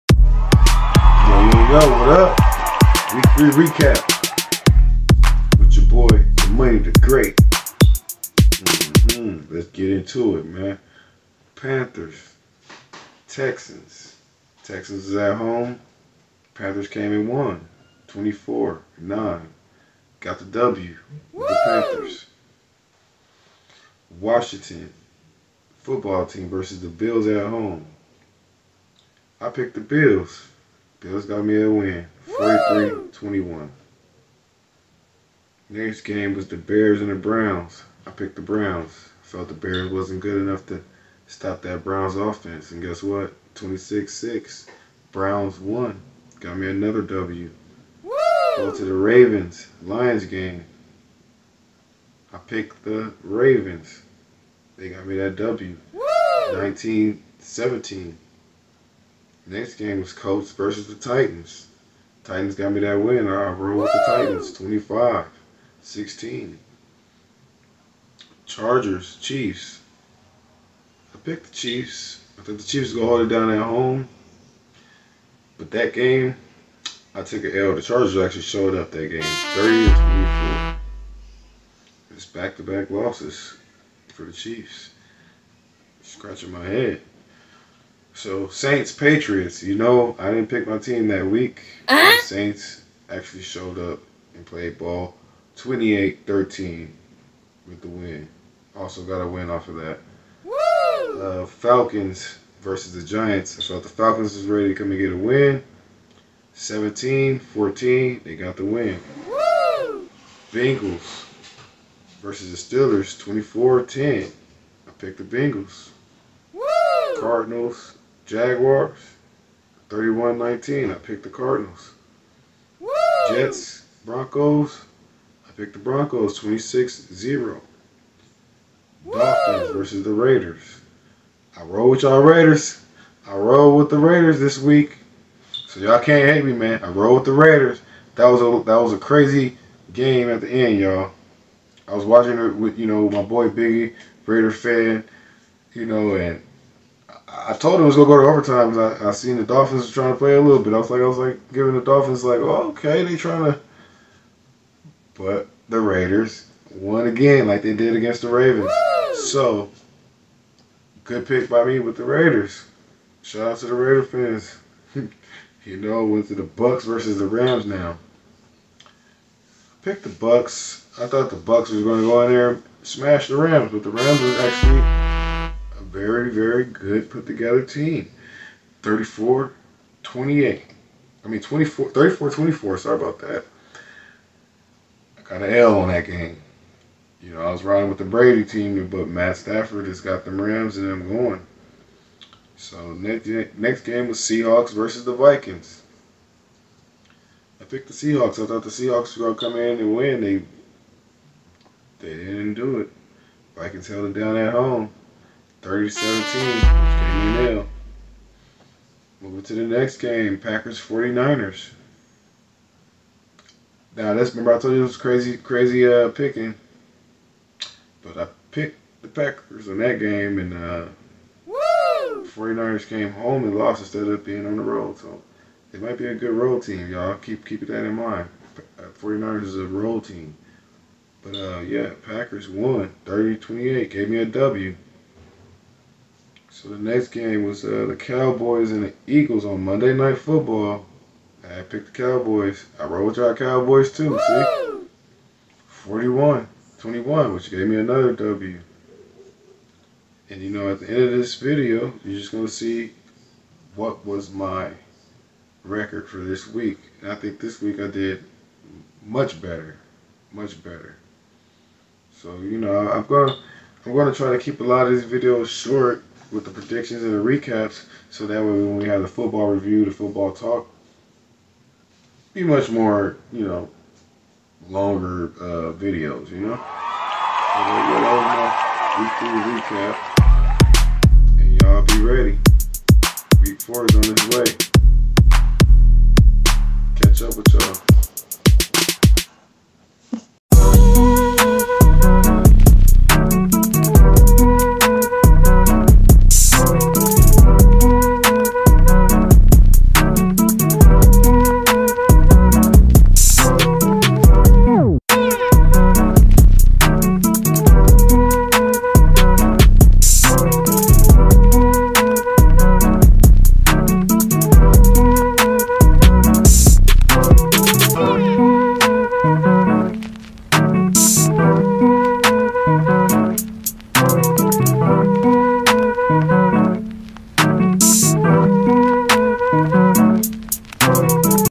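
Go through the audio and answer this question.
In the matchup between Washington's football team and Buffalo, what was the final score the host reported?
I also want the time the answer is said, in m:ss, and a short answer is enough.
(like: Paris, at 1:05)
43-21, at 0:32.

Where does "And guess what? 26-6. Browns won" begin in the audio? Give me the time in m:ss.
0:42.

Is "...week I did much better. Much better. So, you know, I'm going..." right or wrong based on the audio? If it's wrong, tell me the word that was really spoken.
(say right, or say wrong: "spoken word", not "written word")
right.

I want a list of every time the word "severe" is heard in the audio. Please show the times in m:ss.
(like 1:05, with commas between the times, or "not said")
not said.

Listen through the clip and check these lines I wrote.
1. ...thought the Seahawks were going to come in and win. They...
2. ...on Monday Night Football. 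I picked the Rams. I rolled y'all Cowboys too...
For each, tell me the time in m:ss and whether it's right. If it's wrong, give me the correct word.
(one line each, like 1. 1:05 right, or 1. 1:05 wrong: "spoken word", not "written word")
1. 3:18 right
2. 3:59 wrong: "Cowboys", not "Rams".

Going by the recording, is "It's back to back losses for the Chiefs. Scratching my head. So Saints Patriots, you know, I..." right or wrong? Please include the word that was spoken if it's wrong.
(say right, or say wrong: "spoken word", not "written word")
right.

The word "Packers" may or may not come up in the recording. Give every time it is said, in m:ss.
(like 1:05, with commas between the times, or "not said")
3:30, 3:39, 3:52.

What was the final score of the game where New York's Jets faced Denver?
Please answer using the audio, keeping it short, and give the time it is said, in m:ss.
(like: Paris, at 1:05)
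26-0, at 2:06.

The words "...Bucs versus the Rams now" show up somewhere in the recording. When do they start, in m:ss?
2:46.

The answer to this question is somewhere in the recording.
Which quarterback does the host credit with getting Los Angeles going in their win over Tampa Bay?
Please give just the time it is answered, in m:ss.
3:09.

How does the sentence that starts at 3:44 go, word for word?
So they might be a good road team, y'all.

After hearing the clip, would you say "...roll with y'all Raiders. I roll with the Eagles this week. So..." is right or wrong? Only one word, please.
wrong.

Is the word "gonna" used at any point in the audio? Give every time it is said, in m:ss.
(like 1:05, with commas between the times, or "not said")
2:27, 2:51.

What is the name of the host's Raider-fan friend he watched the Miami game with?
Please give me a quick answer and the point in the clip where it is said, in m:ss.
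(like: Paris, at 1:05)
Biggie, at 2:23.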